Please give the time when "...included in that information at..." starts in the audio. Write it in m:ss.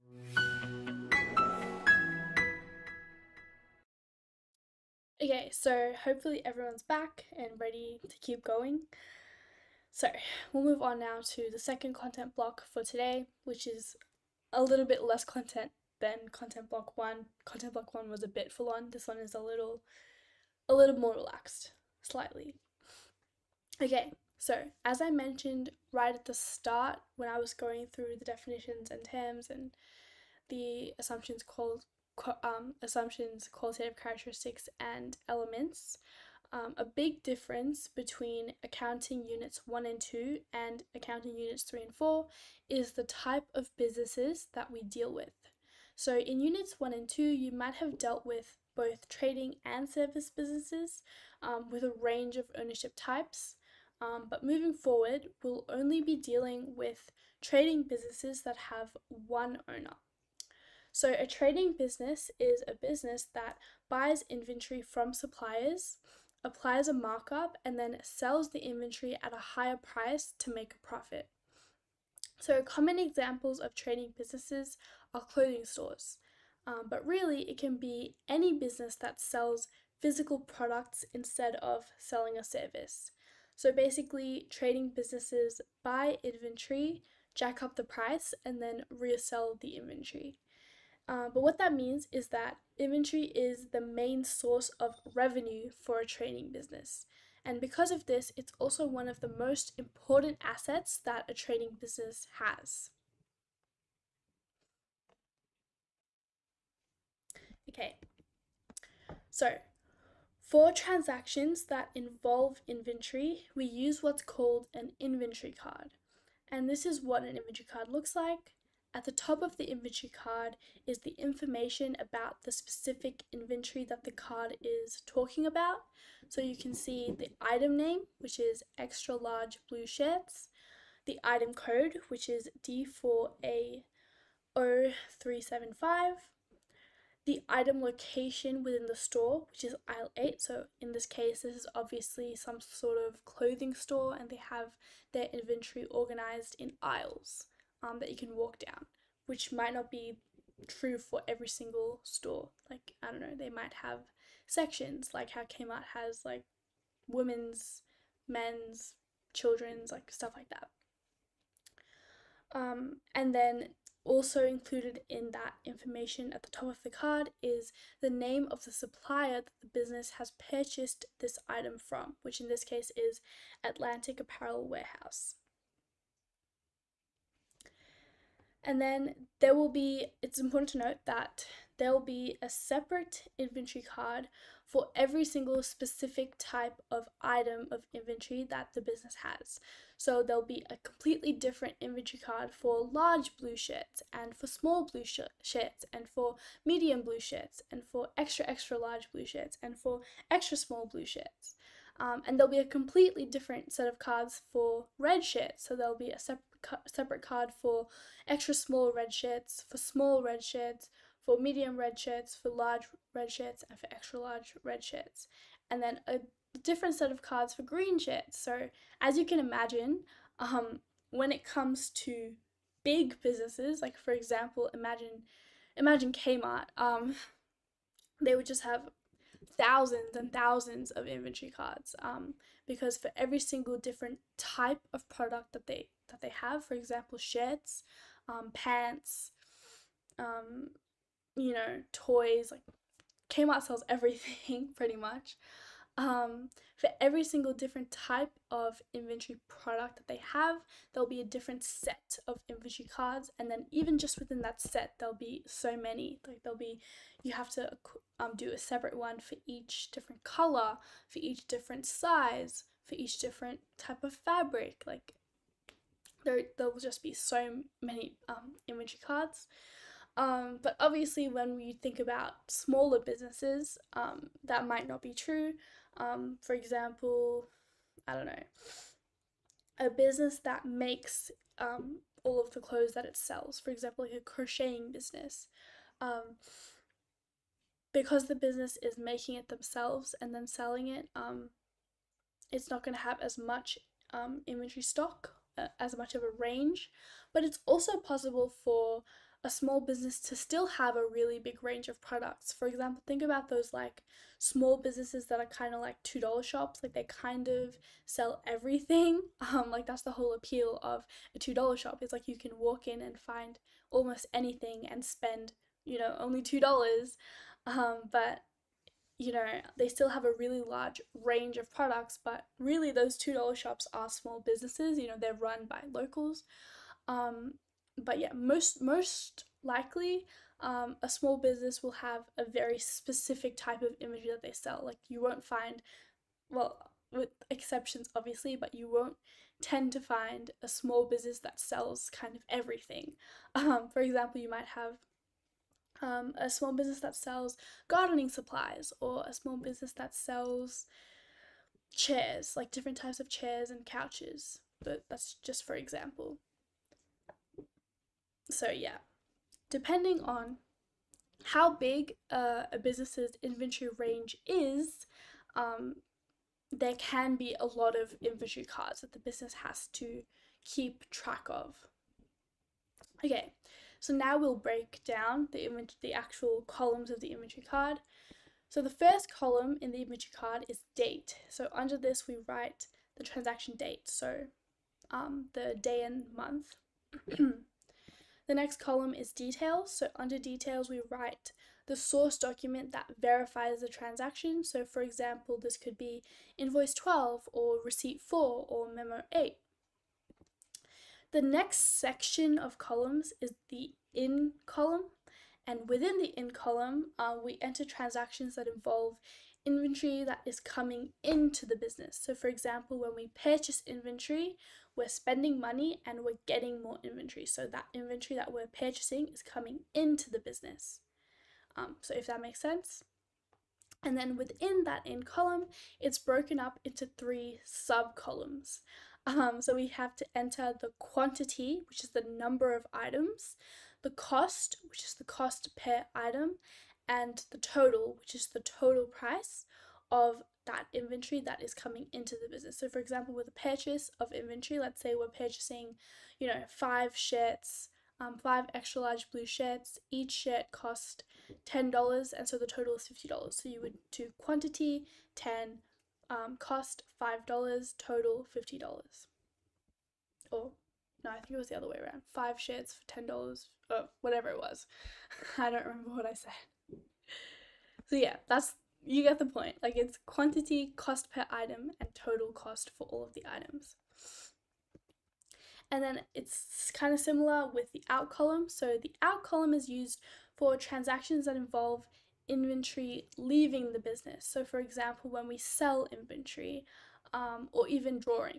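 2:44.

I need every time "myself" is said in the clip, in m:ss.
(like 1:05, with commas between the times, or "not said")
not said.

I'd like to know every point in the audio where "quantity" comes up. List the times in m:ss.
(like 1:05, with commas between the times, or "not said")
7:10, 7:34, 7:50.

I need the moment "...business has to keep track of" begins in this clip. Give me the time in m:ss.
6:09.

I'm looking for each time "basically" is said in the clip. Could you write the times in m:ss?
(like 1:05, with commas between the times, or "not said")
1:23.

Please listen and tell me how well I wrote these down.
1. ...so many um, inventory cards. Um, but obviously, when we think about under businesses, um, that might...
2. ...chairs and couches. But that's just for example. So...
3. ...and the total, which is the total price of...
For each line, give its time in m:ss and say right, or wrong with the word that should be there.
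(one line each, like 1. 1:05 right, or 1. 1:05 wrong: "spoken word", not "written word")
1. 4:27 wrong: "smaller", not "under"
2. 5:53 right
3. 7:17 right.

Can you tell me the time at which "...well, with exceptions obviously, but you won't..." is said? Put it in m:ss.
5:36.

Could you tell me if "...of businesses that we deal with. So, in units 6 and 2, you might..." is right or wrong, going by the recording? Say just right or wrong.
wrong.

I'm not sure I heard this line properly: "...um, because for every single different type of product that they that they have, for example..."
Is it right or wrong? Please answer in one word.
right.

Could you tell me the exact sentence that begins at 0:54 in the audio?
Um, but moving forward, we'll only be dealing with trading businesses that have one owner.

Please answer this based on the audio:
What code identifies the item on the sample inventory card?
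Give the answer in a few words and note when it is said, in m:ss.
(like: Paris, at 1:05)
D4A0375, at 2:12.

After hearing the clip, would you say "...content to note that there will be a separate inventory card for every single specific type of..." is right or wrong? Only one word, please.
wrong.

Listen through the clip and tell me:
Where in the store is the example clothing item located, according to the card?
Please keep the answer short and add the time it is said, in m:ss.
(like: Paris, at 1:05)
Aisle 8, at 2:19.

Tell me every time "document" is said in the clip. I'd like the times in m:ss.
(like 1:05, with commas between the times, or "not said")
6:32.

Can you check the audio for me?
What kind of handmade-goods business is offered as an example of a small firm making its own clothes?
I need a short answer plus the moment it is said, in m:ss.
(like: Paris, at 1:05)
Crocheting business, at 4:44.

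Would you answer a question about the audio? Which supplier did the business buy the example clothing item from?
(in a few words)
Atlantic Apparel Warehouse.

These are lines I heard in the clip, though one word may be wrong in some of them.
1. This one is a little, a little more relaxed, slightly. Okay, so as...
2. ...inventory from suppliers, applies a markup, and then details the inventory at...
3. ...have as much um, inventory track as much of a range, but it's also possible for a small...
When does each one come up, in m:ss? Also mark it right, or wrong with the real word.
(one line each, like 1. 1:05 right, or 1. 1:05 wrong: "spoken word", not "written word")
1. 0:18 right
2. 1:04 wrong: "sells", not "details"
3. 4:53 wrong: "stock", not "track".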